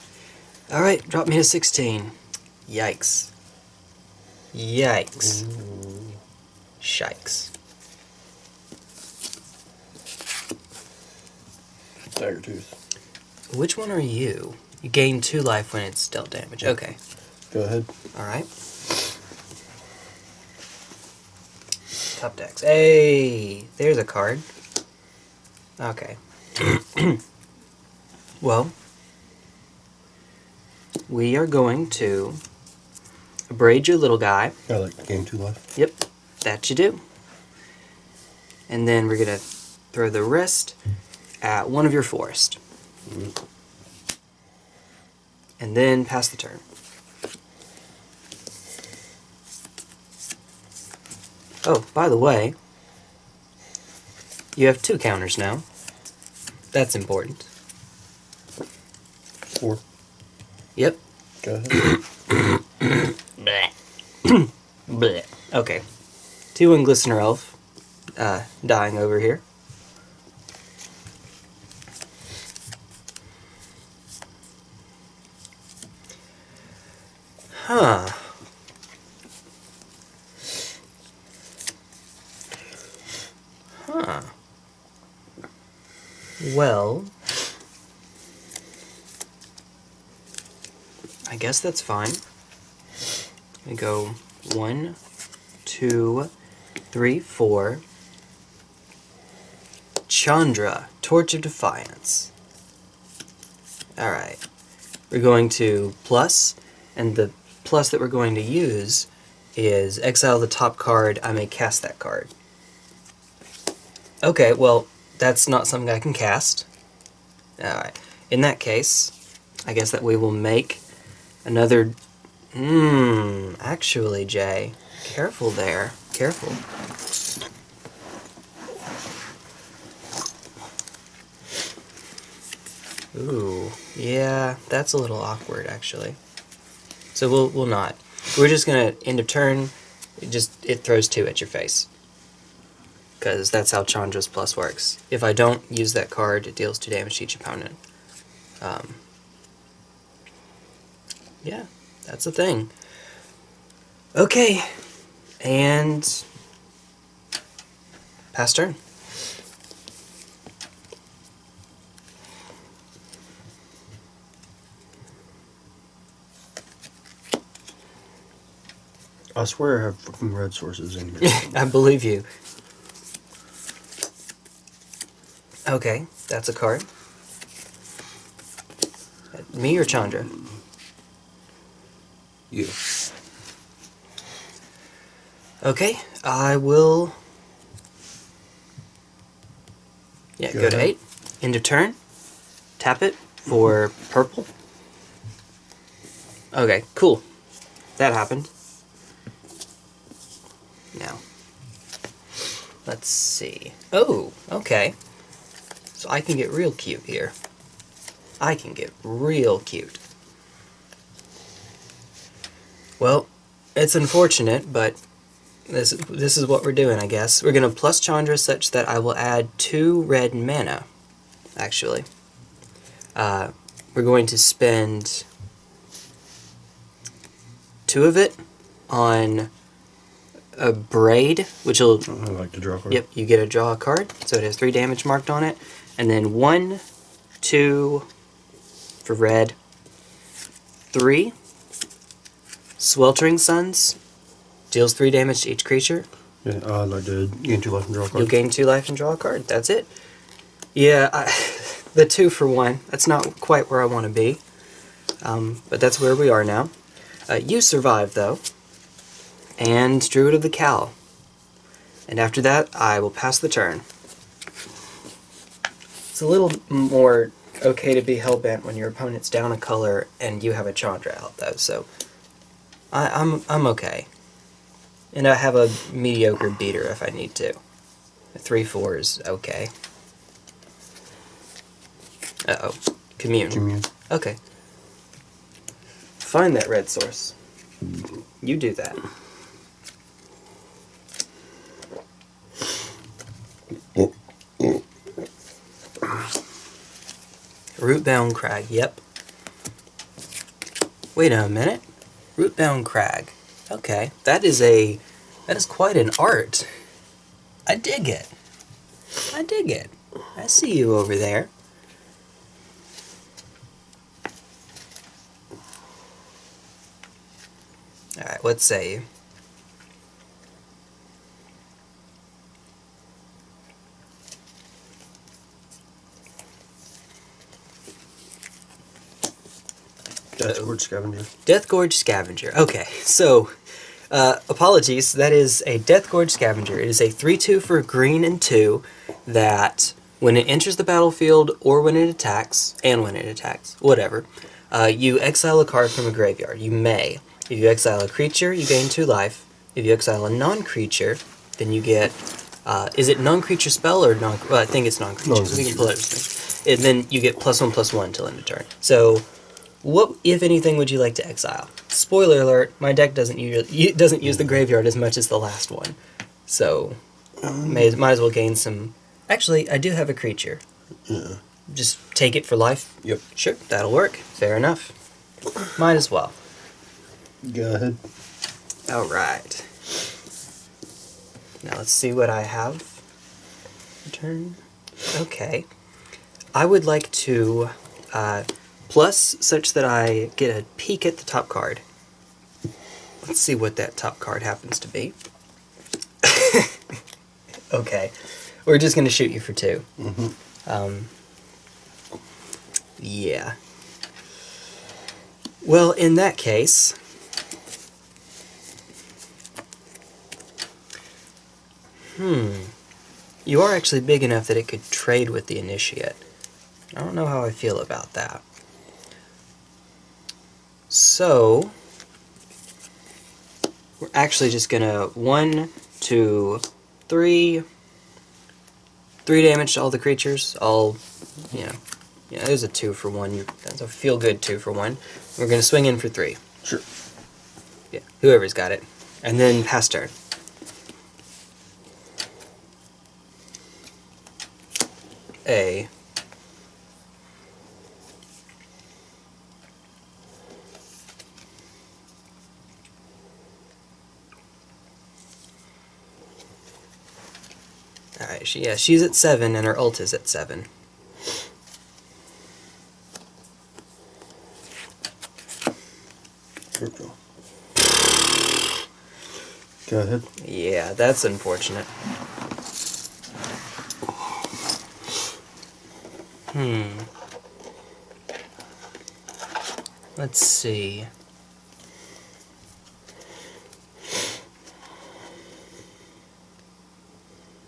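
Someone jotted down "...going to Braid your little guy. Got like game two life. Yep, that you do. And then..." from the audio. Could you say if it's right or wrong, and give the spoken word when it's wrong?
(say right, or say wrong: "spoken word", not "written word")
right.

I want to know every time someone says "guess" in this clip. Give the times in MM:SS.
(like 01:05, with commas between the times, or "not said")
01:31, 01:59, 03:37.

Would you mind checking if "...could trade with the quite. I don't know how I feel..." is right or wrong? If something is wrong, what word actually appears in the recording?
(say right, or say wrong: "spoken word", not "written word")
wrong: "initiate", not "quite".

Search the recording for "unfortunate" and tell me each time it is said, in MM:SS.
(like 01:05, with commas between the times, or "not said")
03:33, 07:51.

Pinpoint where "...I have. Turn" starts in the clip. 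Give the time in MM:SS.
06:22.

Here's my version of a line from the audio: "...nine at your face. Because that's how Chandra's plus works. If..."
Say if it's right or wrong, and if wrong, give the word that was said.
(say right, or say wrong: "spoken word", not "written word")
wrong: "two", not "nine".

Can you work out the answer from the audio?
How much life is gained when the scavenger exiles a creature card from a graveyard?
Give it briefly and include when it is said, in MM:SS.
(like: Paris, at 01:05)
2, at 05:48.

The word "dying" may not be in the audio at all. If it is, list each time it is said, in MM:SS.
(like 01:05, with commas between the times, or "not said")
01:08.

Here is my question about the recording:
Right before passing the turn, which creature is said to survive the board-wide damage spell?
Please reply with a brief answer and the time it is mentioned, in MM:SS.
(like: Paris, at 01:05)
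Druid of the Cowl, at 04:20.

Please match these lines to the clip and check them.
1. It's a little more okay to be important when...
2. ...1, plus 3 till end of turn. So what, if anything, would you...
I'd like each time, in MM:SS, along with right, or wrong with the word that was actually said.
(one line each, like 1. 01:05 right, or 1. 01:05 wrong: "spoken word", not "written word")
1. 04:25 wrong: "hellbent", not "important"
2. 05:57 wrong: "1", not "3".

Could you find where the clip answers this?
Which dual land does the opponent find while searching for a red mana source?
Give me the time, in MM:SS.
04:57.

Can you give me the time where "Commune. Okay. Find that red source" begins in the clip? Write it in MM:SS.
04:43.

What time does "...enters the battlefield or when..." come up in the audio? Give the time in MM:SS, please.
05:40.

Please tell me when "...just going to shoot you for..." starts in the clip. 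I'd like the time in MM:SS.
06:38.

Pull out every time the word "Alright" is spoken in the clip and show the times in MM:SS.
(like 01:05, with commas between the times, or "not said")
01:43, 01:57, 05:18.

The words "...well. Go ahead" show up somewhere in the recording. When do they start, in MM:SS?
06:16.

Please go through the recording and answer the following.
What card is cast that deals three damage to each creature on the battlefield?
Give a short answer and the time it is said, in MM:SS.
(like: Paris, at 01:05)
Sweltering Suns, at 04:02.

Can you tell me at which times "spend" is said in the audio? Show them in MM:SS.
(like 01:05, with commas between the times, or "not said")
03:44.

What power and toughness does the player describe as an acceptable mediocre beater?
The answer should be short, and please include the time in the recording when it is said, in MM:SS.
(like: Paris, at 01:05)
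3-4, at 04:38.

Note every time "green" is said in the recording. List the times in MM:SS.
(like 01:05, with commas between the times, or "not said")
05:37.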